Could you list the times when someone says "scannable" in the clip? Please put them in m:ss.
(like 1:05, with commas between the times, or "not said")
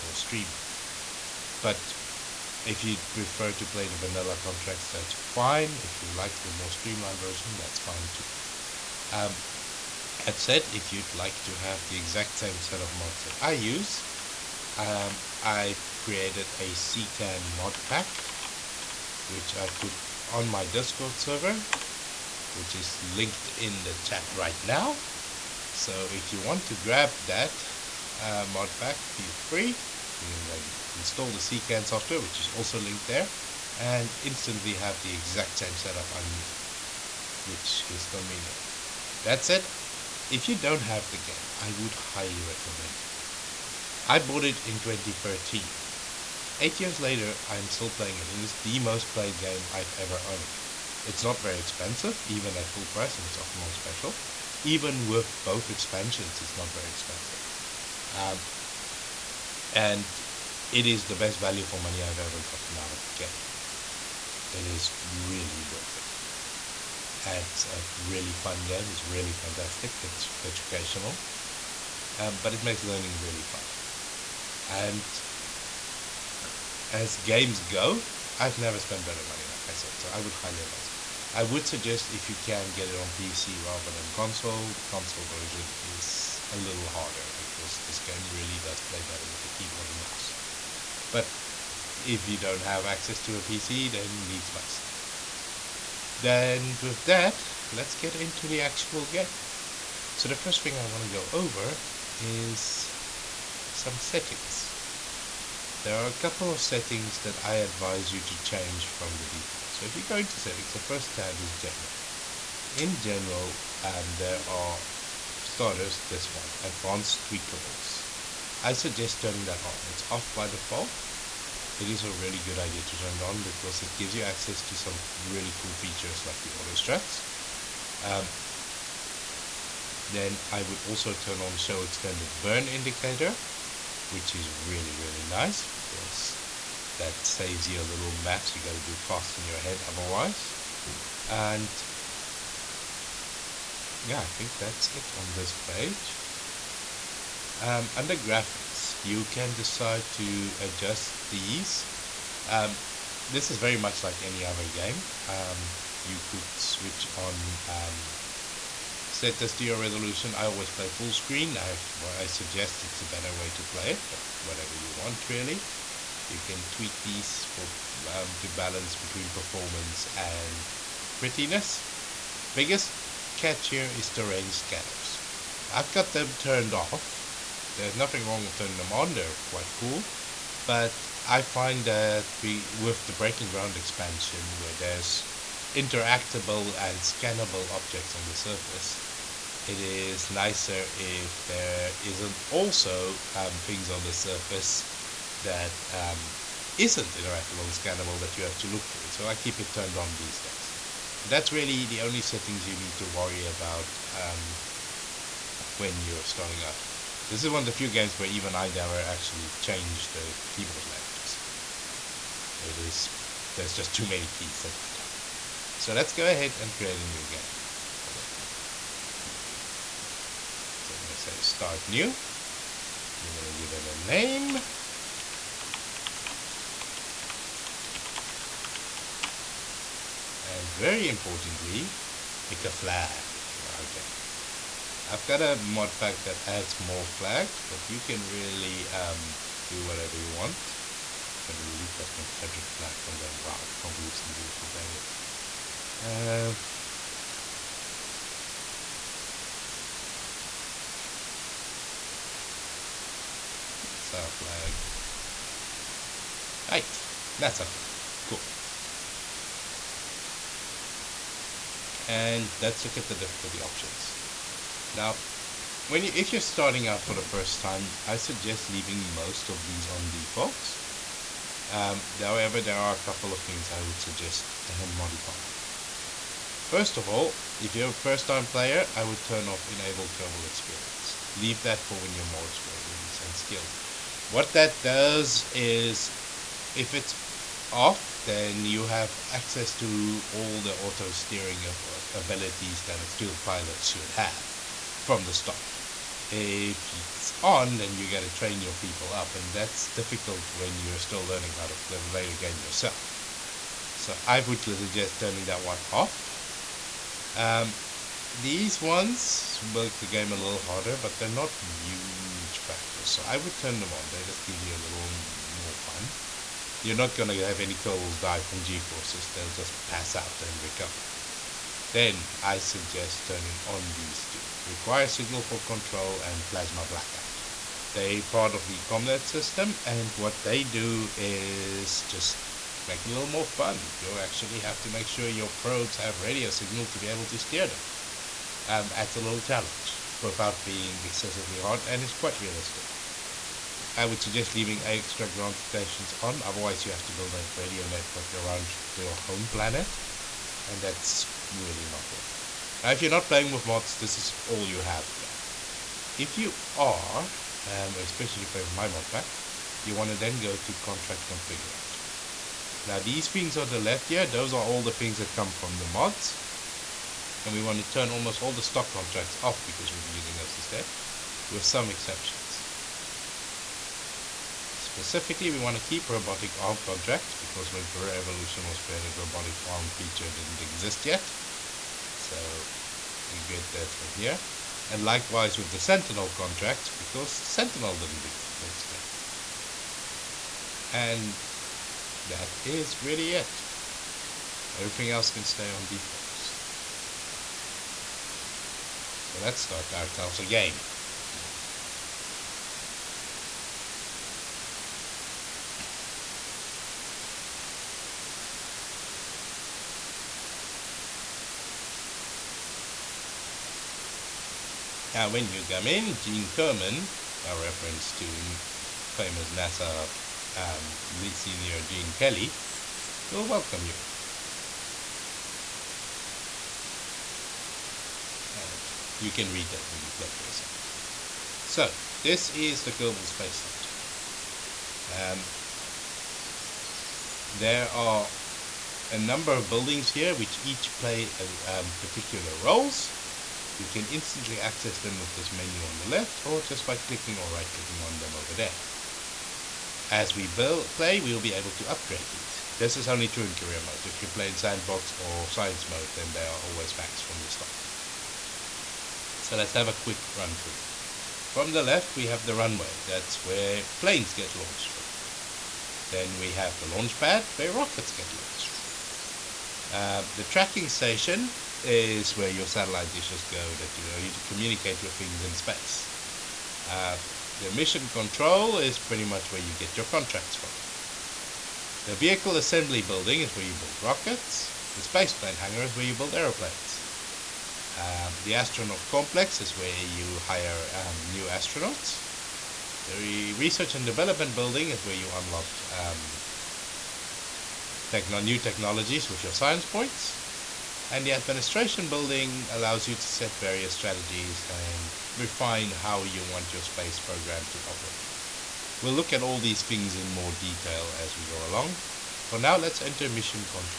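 3:07, 3:17.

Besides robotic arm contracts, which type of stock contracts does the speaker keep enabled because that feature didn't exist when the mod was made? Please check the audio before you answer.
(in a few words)
Sentinel contracts.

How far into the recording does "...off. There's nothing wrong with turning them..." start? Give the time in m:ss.
2:56.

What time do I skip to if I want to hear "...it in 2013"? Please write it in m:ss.
0:44.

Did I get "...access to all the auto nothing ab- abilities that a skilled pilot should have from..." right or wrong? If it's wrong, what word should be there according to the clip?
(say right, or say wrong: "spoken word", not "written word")
wrong: "steering", not "nothing".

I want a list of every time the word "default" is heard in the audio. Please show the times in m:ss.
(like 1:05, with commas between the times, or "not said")
1:49, 2:00, 4:30, 6:35.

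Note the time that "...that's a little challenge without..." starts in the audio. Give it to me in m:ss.
5:38.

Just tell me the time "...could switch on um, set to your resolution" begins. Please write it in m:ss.
2:36.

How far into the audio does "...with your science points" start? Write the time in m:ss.
8:19.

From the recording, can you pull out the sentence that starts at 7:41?
From the left, we have the runway.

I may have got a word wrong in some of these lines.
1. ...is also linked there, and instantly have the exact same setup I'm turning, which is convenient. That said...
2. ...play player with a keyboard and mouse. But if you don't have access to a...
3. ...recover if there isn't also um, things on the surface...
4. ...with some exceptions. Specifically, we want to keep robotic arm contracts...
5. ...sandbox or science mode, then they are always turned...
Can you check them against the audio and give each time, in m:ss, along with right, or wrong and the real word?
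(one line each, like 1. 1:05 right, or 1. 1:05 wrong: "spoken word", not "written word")
1. 0:32 wrong: "using", not "turning"
2. 1:28 wrong: "better", not "player"
3. 3:10 wrong: "nicer", not "recover"
4. 6:11 right
5. 7:34 wrong: "maxed", not "turned".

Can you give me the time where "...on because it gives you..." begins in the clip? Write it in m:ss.
2:03.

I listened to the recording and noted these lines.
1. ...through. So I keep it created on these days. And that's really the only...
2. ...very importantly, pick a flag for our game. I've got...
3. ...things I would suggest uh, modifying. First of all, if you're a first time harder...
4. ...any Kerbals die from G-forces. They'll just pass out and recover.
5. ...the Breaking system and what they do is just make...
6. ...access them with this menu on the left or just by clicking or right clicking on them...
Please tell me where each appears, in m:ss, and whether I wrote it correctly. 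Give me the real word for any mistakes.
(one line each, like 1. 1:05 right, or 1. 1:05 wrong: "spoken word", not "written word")
1. 3:18 wrong: "turned", not "created"
2. 3:50 right
3. 4:33 wrong: "player", not "harder"
4. 5:17 right
5. 5:28 wrong: "CommNet", not "Breaking"
6. 7:24 right.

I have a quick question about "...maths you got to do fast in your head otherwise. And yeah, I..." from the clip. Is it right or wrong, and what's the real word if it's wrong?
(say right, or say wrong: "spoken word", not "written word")
right.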